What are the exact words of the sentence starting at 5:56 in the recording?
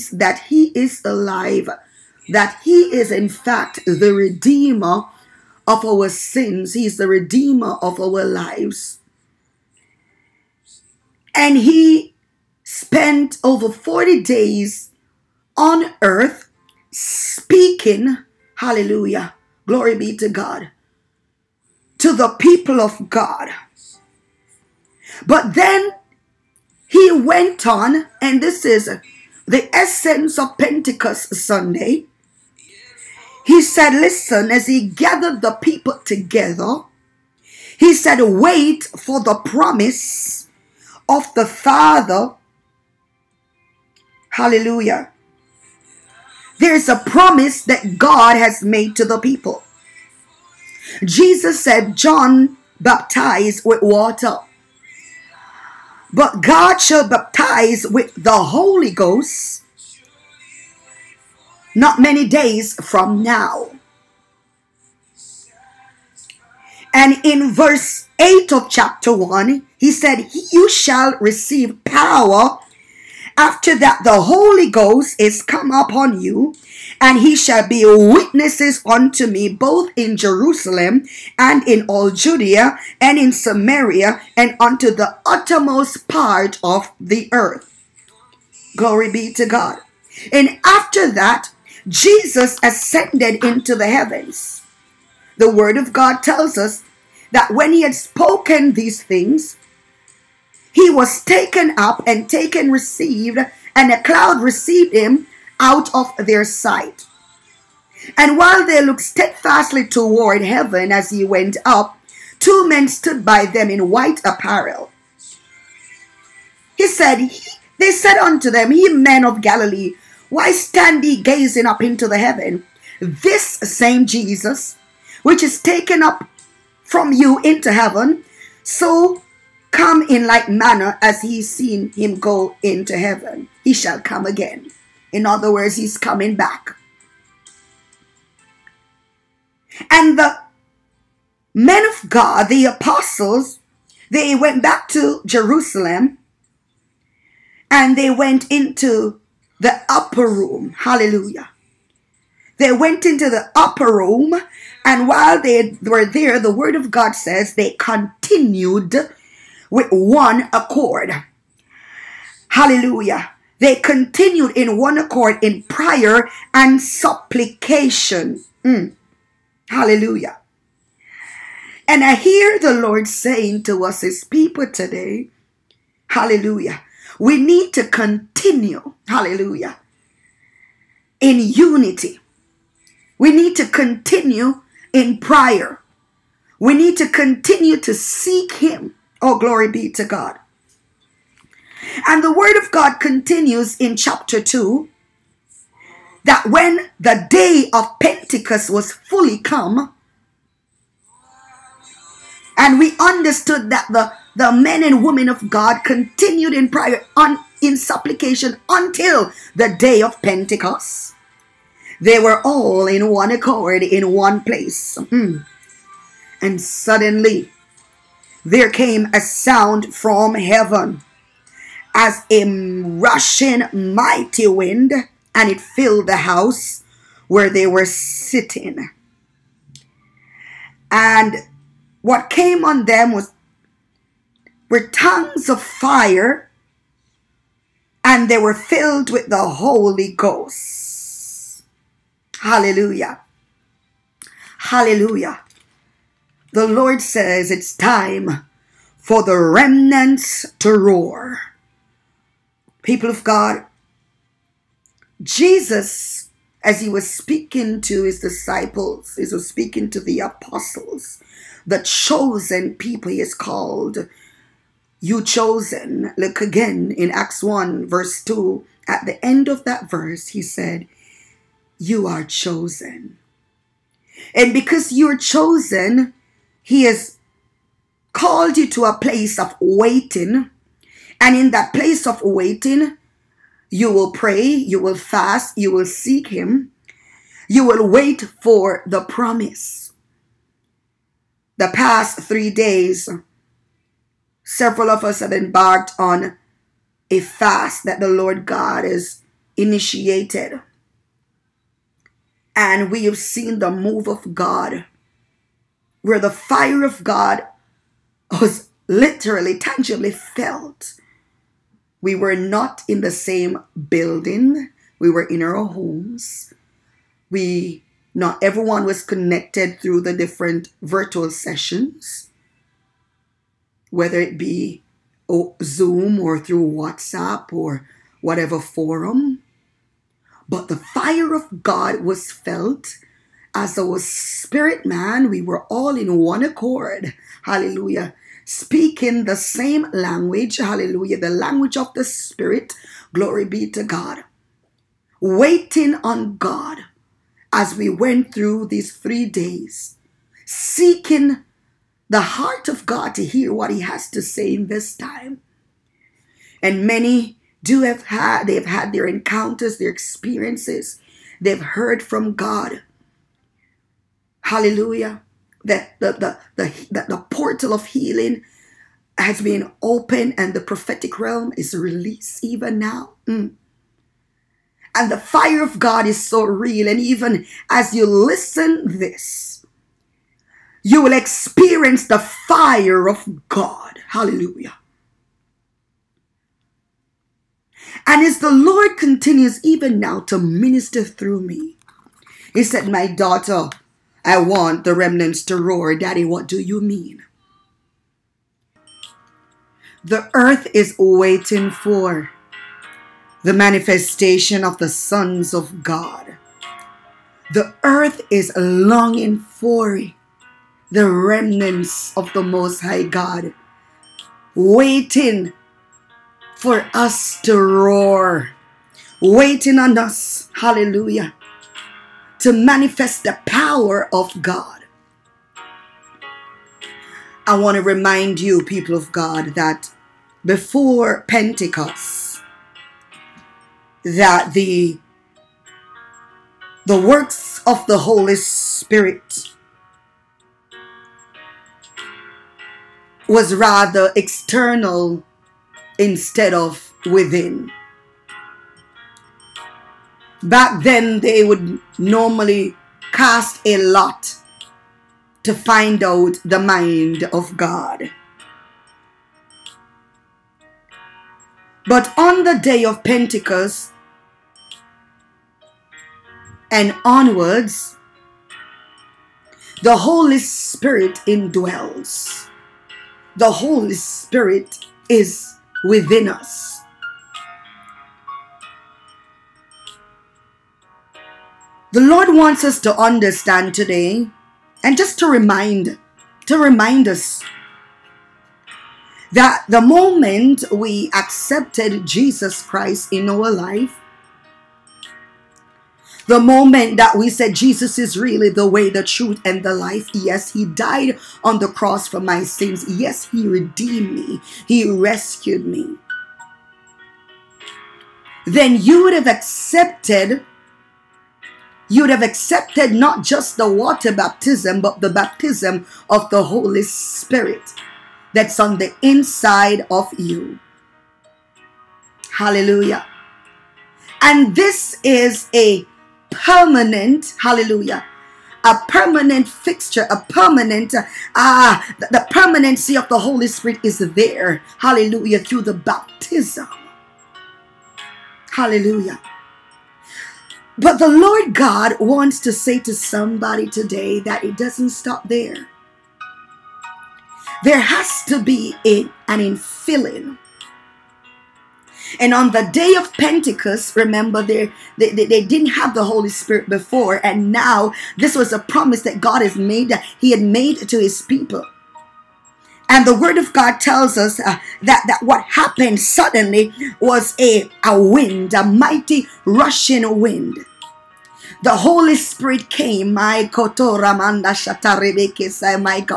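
And many do have had, they've had their encounters, their experiences, they've heard from God.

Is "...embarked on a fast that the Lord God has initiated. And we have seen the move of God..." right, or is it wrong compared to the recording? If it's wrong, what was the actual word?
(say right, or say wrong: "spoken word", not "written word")
right.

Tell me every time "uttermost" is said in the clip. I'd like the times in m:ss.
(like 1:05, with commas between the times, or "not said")
1:25.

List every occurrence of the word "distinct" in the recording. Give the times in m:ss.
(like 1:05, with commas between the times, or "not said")
not said.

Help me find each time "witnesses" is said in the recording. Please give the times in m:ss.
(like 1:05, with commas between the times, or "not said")
1:17.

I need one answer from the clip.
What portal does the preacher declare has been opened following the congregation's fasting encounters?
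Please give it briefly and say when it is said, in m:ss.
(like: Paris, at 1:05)
Healing, at 6:07.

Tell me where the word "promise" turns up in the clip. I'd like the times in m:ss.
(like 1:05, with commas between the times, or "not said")
0:39, 0:47, 4:49, 9:18.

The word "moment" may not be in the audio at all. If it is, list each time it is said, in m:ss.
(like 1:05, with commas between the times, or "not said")
8:09, 8:16.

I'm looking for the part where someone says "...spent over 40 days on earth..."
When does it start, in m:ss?
0:12.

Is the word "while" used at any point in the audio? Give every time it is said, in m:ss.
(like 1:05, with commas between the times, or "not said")
1:48, 2:35.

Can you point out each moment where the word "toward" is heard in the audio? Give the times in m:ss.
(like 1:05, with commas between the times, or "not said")
1:49.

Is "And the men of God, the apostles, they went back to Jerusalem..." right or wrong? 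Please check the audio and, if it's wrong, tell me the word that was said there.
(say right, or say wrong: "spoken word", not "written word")
right.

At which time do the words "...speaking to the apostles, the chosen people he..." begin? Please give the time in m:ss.
4:19.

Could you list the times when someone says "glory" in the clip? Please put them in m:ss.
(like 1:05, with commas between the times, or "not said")
0:19, 1:28, 3:09, 5:43.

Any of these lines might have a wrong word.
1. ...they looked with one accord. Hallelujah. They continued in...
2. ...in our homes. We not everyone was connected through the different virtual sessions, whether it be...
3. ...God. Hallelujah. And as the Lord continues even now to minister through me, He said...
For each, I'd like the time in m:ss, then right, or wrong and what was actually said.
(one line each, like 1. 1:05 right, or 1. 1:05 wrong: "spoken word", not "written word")
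1. 2:37 wrong: "continued", not "looked"
2. 5:15 right
3. 6:23 right.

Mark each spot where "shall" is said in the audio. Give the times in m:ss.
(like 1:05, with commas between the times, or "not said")
0:56, 1:10, 1:17, 2:13.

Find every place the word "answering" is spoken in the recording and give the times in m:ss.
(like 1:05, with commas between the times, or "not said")
not said.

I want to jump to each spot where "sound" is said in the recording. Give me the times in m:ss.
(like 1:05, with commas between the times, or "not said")
3:39.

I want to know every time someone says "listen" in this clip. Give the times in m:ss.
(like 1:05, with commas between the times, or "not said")
0:33, 6:18.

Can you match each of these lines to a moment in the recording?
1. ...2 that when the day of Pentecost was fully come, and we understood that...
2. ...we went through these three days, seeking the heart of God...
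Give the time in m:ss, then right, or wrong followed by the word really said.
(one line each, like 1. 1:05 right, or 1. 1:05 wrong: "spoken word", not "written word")
1. 3:14 right
2. 5:47 right.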